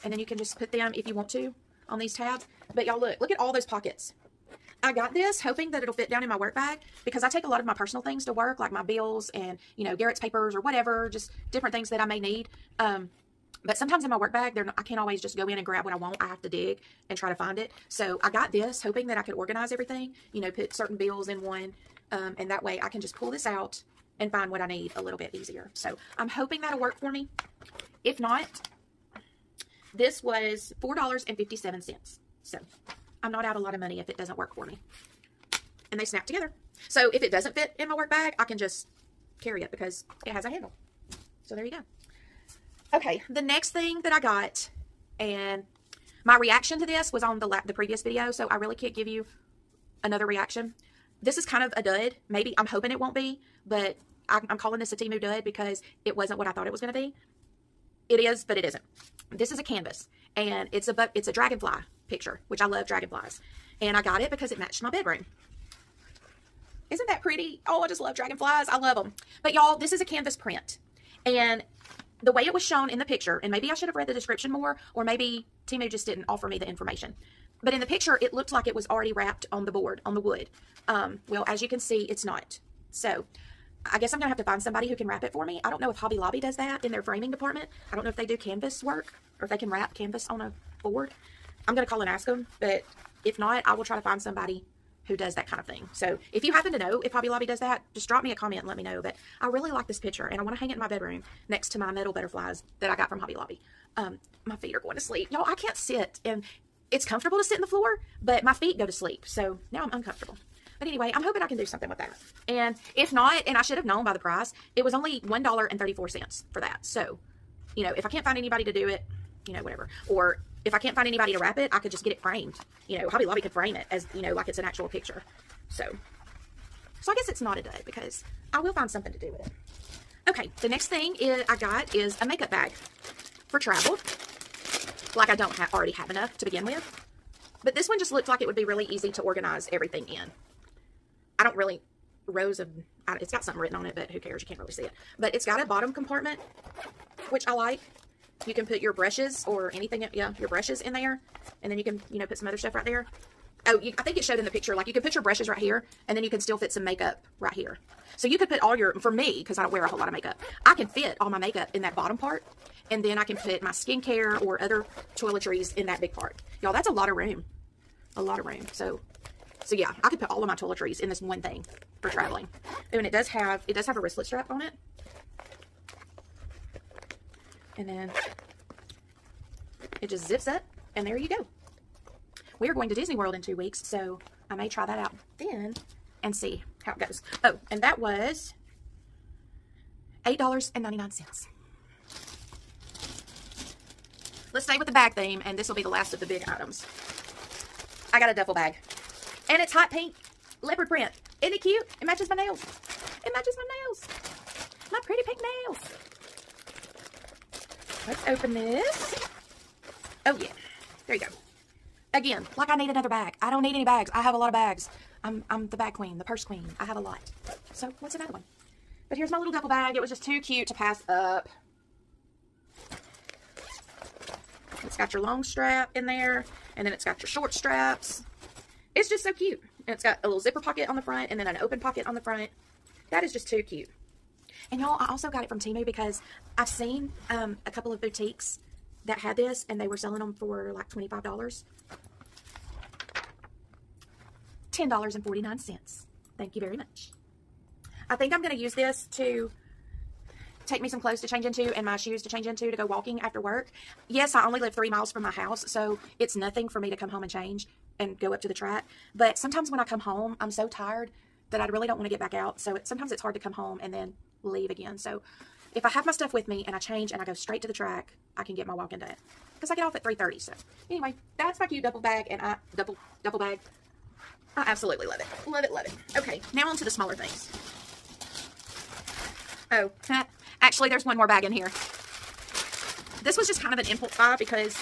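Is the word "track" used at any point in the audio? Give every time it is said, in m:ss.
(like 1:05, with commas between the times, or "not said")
4:18, 4:27.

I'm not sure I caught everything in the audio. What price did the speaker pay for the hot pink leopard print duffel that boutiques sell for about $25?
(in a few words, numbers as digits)
$10.49.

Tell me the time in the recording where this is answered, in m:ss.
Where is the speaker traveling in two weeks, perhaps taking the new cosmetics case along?
3:02.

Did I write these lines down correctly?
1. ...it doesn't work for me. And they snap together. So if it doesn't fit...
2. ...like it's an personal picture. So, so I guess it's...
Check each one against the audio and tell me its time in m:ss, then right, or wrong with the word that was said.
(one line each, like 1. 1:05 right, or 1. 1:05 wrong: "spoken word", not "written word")
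1. 0:34 right
2. 2:04 wrong: "actual", not "personal".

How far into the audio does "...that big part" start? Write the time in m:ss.
2:45.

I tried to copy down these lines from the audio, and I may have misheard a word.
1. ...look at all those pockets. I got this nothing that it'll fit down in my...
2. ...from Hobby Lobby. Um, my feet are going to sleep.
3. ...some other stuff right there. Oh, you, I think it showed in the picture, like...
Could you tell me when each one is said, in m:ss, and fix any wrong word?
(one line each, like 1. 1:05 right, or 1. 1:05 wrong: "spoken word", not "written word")
1. 0:03 wrong: "hoping", not "nothing"
2. 1:43 right
3. 2:32 right.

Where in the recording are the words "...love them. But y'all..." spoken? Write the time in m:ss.
1:08.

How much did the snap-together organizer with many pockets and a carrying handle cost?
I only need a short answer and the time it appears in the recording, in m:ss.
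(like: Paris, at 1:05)
$4.57, at 0:30.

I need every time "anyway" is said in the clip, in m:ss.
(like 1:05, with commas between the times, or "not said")
1:50, 4:30.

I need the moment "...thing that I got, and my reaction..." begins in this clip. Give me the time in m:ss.
0:43.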